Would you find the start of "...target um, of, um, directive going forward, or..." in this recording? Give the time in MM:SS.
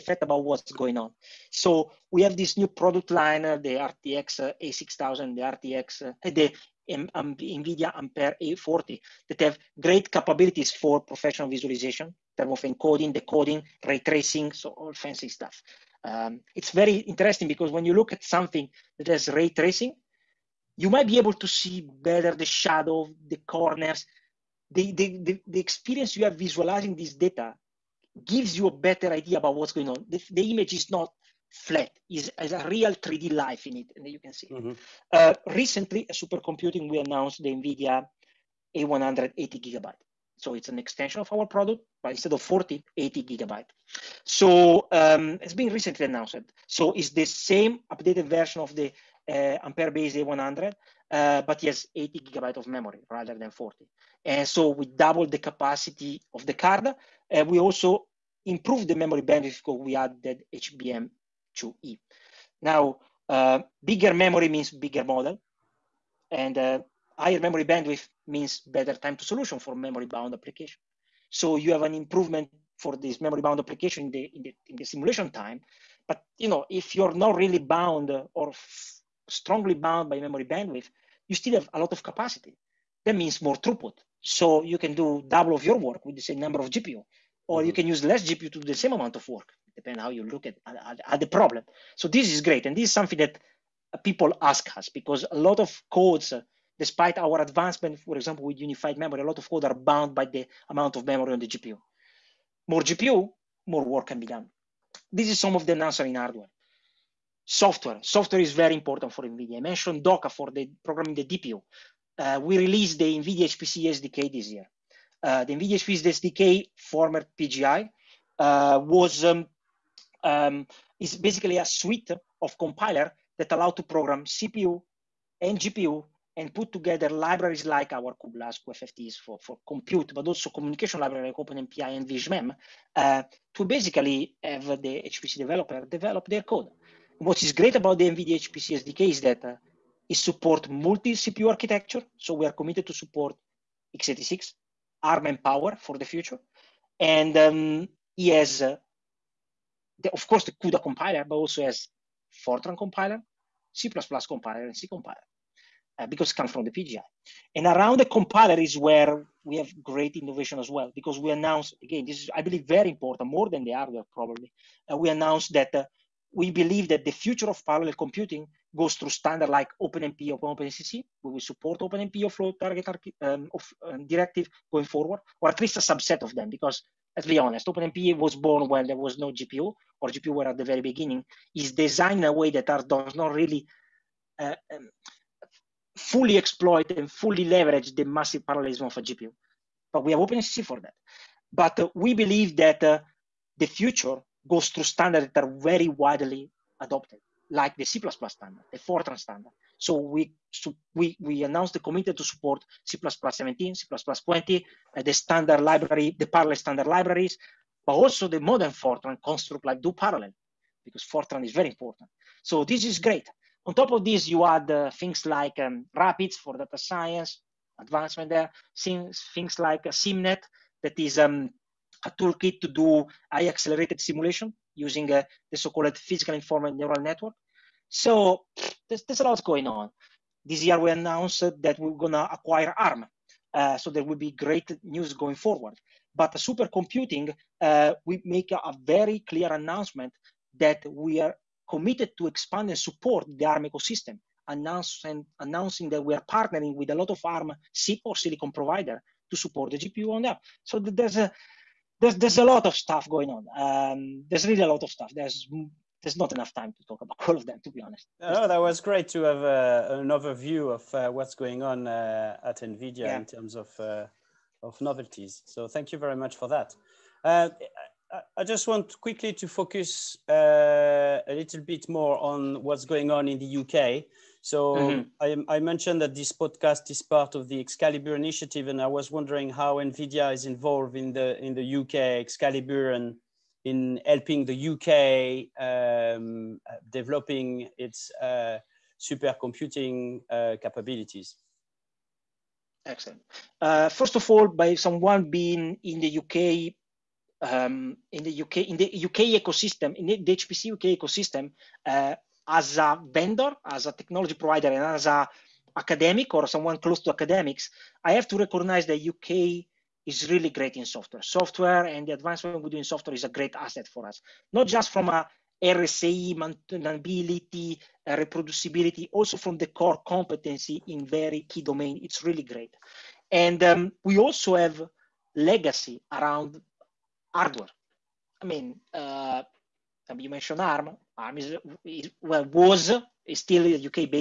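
02:52.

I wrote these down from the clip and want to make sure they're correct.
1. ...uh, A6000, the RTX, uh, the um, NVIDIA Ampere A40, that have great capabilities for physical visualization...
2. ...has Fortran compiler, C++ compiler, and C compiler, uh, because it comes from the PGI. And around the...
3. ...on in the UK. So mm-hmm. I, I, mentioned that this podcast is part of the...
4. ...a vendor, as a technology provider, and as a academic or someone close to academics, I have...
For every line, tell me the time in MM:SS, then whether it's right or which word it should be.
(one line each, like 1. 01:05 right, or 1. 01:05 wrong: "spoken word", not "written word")
1. 00:04 wrong: "professional", not "physical"
2. 02:31 right
3. 04:33 right
4. 05:02 right.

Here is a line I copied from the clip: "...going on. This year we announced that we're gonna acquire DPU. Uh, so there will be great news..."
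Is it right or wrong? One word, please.
wrong.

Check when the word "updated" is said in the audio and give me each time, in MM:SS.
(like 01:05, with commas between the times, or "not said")
00:47.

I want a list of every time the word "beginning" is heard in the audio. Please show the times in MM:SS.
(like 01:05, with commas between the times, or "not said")
03:00.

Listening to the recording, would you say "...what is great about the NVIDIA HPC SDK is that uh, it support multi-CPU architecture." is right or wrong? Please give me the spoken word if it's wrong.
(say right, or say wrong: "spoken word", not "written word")
right.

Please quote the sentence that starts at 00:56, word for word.
Uh, we also improved the memory bandwidth because we added HBM2E.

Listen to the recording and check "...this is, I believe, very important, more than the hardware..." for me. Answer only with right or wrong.
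right.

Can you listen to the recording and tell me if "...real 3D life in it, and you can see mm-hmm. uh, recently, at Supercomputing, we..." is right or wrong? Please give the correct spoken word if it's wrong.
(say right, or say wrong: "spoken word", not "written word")
right.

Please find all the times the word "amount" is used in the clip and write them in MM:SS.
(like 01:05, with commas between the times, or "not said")
01:28, 01:40.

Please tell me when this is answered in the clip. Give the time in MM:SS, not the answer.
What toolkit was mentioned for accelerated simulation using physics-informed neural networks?
03:39.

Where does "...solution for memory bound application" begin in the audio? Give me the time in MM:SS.
01:09.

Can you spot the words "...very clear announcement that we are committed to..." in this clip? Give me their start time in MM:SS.
03:58.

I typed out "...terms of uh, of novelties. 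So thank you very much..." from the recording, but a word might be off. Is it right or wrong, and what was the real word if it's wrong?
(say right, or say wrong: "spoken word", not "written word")
right.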